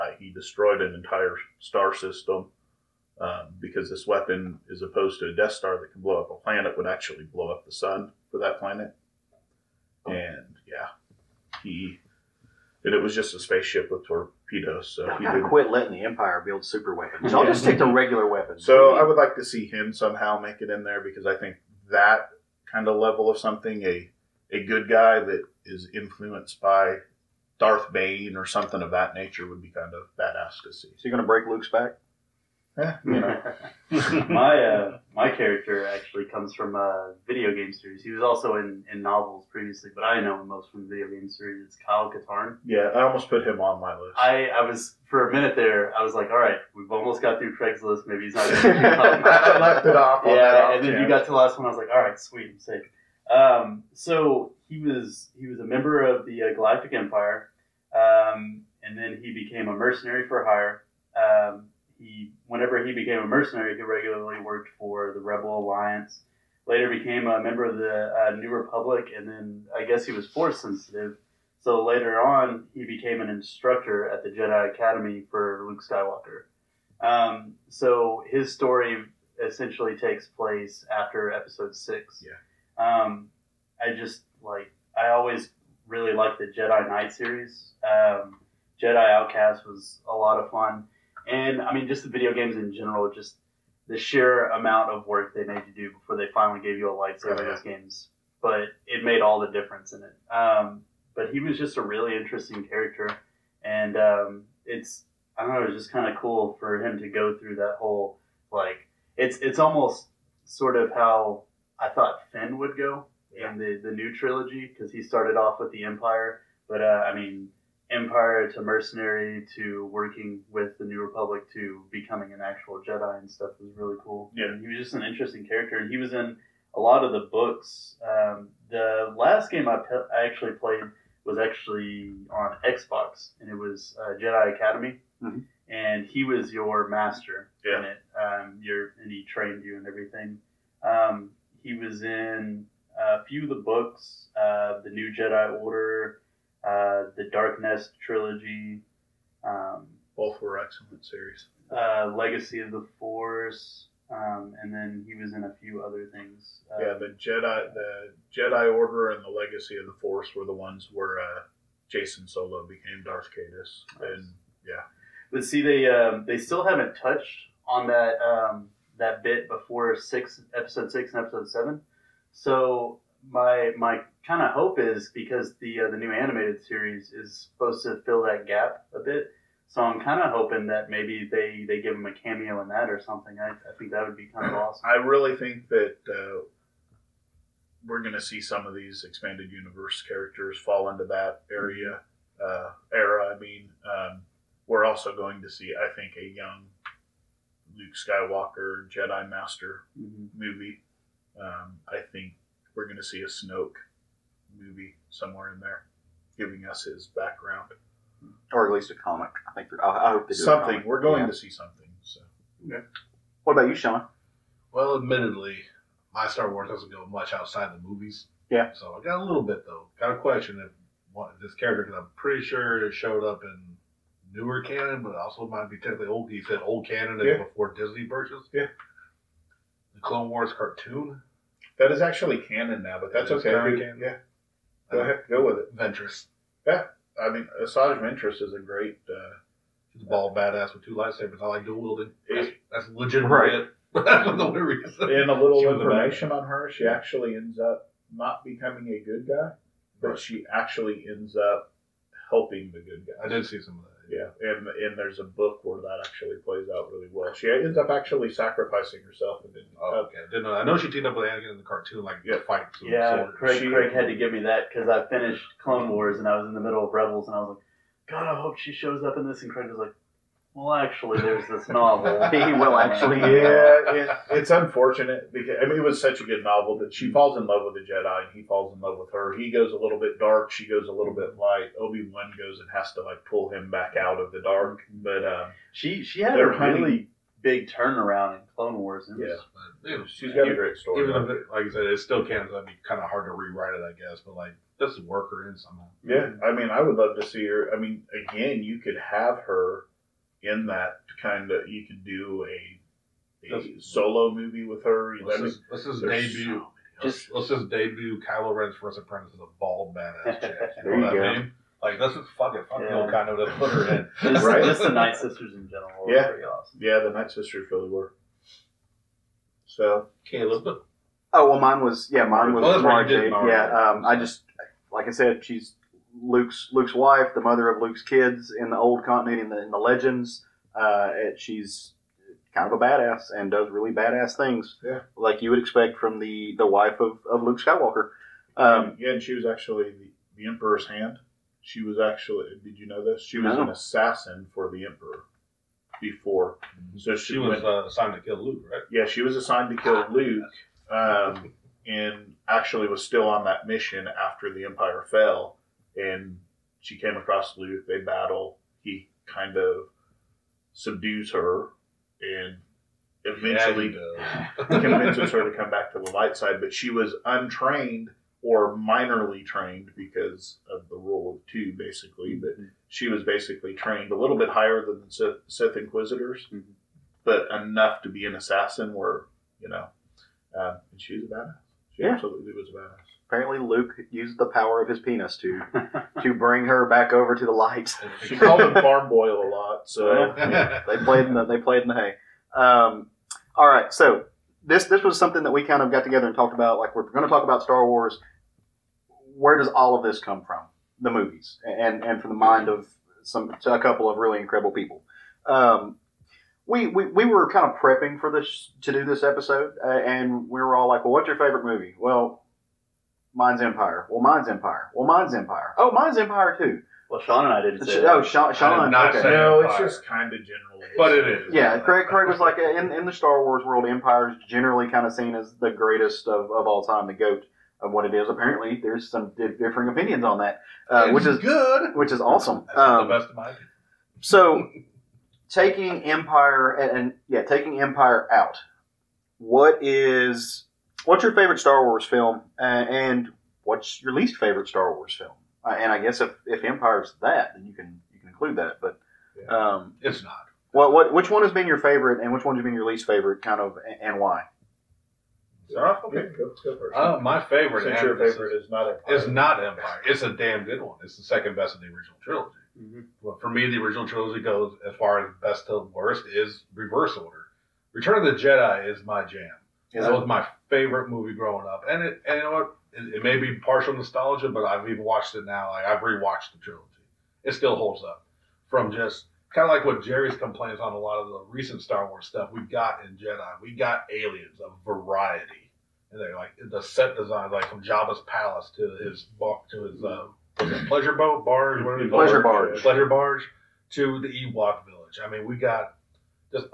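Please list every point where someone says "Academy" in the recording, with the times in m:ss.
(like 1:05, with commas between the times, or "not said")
1:14, 2:14.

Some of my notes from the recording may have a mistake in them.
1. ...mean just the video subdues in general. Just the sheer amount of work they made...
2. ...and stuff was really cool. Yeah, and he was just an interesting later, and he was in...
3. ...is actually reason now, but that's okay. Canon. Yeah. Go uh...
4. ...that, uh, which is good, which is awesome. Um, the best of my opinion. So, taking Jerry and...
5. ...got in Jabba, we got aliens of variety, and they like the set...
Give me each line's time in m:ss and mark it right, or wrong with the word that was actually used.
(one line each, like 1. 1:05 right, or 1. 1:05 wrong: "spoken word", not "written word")
1. 1:31 wrong: "games", not "subdues"
2. 2:03 wrong: "character", not "later"
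3. 3:51 wrong: "canon", not "reason"
4. 7:10 wrong: "Empire", not "Jerry"
5. 8:02 wrong: "Jedi", not "Jabba".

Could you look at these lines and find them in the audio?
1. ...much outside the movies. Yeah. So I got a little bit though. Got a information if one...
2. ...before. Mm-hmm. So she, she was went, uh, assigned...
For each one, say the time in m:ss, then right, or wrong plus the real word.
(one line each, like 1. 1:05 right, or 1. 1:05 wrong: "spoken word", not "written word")
1. 3:37 wrong: "question", not "information"
2. 5:45 right.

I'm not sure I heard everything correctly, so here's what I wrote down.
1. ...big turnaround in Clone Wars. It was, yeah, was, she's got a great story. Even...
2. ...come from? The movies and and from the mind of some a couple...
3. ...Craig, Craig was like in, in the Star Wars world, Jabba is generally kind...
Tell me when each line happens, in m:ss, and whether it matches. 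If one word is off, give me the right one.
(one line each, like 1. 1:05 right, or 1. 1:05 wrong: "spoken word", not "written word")
1. 4:47 right
2. 6:40 right
3. 7:01 wrong: "Empire", not "Jabba".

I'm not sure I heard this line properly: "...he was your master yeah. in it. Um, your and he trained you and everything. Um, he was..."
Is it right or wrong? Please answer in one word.
right.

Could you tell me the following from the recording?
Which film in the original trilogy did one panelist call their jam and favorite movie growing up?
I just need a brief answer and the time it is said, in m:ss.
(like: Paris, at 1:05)
Return of the Jedi, at 7:47.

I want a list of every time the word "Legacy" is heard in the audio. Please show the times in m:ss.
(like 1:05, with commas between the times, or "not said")
2:32, 2:39.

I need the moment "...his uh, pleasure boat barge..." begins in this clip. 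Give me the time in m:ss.
8:09.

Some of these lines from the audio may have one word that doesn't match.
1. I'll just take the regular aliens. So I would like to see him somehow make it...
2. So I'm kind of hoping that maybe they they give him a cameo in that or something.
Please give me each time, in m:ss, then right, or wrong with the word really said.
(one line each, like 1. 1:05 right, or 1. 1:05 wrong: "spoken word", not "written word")
1. 0:17 wrong: "weapons", not "aliens"
2. 2:59 right.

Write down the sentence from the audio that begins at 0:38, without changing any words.
He was also in, in novels previously, but I know him most from video game series.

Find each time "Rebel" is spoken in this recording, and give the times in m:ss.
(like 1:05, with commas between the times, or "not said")
1:05, 4:26.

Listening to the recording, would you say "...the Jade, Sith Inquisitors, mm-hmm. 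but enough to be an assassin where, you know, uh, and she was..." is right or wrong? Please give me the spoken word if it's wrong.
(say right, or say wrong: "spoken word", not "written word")
wrong: "Sith", not "Jade".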